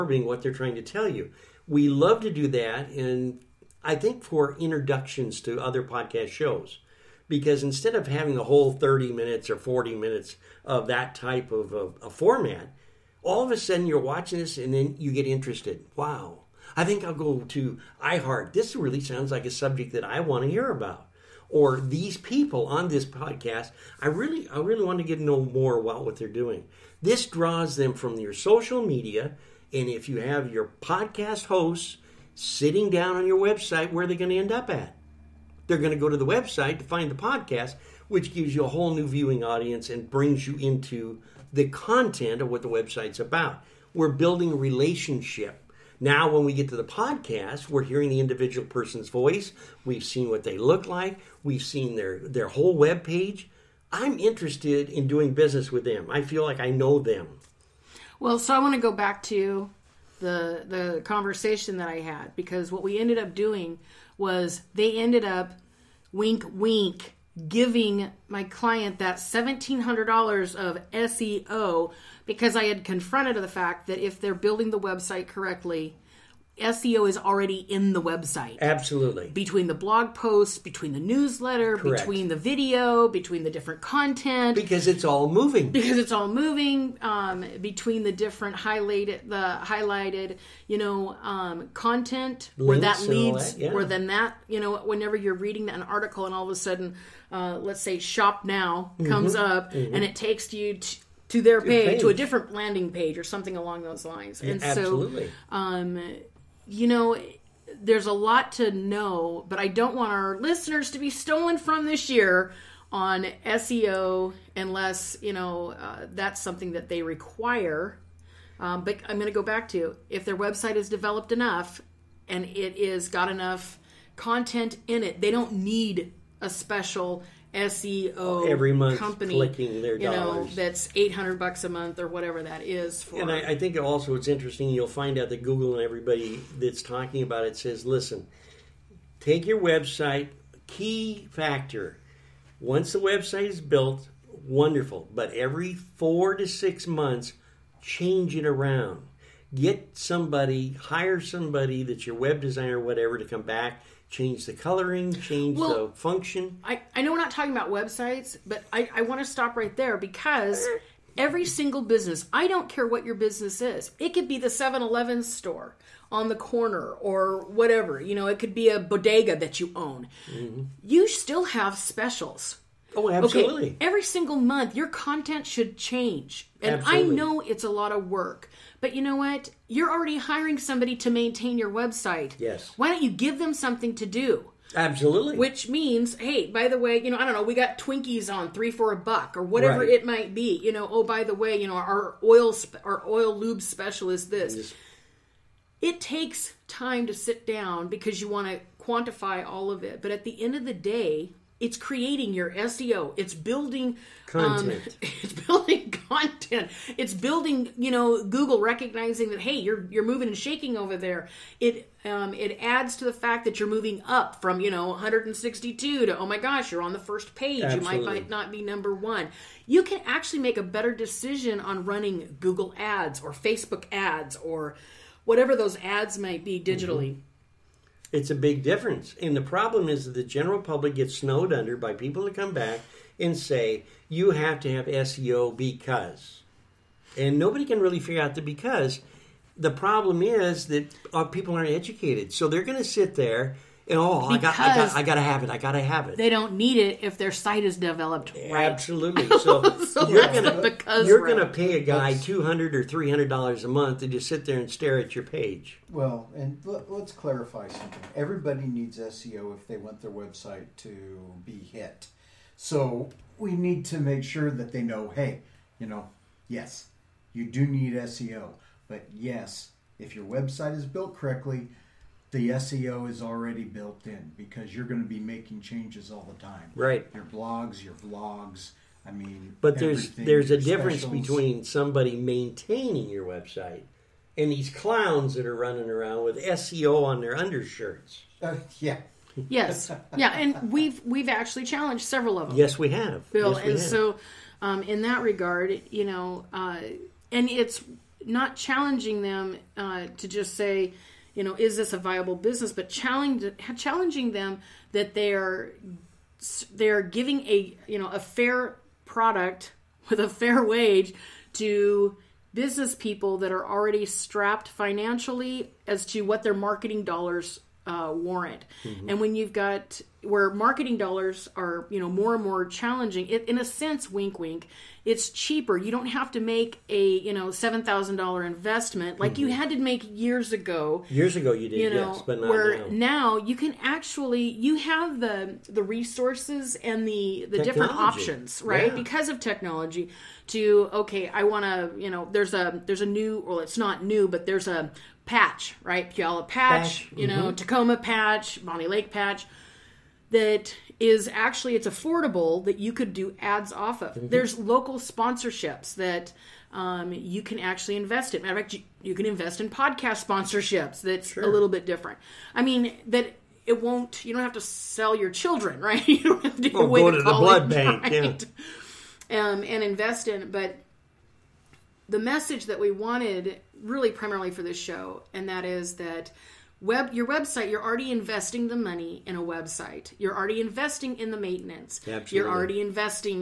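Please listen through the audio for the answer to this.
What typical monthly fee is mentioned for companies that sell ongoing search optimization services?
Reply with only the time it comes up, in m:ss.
2:10.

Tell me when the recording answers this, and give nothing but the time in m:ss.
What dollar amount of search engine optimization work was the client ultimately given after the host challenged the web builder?
1:09.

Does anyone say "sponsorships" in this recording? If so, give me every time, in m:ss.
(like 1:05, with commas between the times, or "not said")
5:55, 6:00.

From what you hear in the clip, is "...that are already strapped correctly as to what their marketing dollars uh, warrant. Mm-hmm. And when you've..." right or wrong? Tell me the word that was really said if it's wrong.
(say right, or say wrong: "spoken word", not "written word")
wrong: "financially", not "correctly".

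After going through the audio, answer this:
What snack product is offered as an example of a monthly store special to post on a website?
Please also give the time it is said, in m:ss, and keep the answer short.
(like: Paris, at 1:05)
Twinkies, at 3:07.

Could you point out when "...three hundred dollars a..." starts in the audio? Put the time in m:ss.
4:12.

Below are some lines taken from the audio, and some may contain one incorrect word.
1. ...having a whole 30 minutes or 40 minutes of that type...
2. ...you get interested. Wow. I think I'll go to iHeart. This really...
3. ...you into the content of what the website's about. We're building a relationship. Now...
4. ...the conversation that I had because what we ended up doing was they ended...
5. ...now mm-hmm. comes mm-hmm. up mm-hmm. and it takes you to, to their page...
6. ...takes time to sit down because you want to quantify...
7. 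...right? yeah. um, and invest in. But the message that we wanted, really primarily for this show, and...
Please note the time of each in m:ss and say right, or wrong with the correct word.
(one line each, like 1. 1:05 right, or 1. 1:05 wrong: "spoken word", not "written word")
1. 0:08 right
2. 0:14 right
3. 0:40 right
4. 1:00 right
5. 1:38 right
6. 3:15 right
7. 6:08 right.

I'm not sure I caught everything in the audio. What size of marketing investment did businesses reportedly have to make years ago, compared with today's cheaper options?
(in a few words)
$7000.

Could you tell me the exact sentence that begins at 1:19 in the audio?
Between the blog posts, between the newsletter, Correct.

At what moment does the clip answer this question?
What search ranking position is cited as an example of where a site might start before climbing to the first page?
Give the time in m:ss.
3:34.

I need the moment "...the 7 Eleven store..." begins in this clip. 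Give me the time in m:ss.
2:44.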